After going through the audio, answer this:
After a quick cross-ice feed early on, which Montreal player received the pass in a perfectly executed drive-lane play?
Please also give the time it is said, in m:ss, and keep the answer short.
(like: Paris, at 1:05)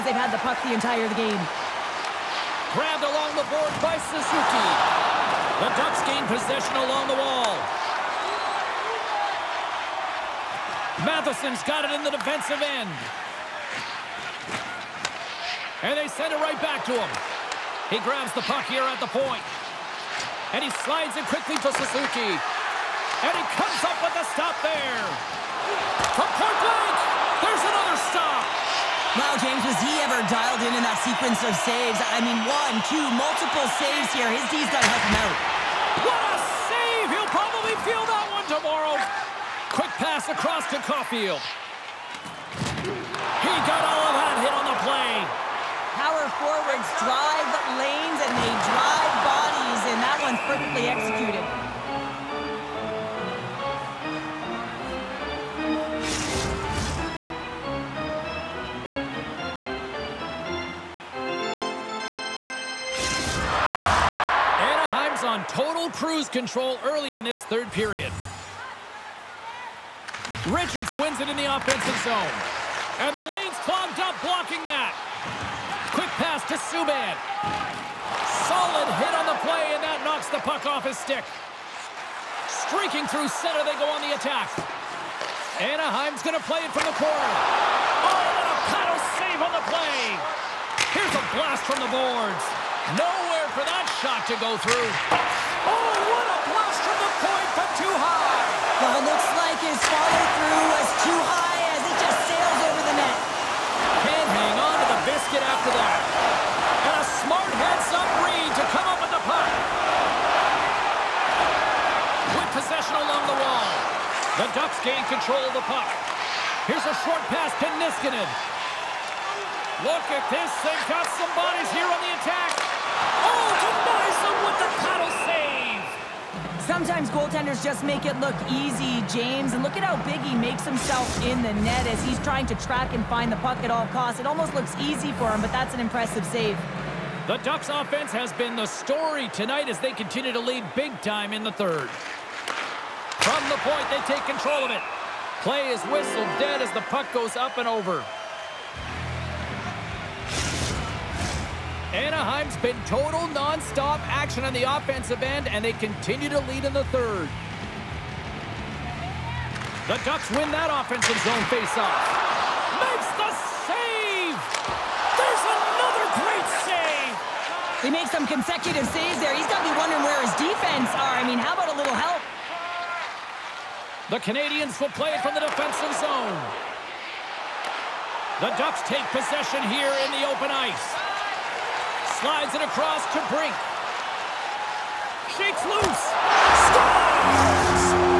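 Caulfield, at 0:40.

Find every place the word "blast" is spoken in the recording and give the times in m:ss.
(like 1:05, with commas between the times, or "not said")
1:31, 1:36.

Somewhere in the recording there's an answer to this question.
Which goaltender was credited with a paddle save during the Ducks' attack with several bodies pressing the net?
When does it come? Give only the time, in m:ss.
2:03.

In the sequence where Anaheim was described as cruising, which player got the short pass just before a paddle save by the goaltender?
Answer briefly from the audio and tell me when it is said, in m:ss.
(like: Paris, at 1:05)
Niskanen, at 1:57.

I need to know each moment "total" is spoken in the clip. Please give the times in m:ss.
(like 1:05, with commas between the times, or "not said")
1:05, 2:32.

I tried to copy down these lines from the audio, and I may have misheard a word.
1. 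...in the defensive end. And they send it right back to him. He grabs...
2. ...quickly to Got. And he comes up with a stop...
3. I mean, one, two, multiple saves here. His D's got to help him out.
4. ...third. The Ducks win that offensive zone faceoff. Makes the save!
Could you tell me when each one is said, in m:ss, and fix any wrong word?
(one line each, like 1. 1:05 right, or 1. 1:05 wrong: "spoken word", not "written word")
1. 0:11 right
2. 0:21 wrong: "Suzuki", not "Got"
3. 0:32 right
4. 2:36 right.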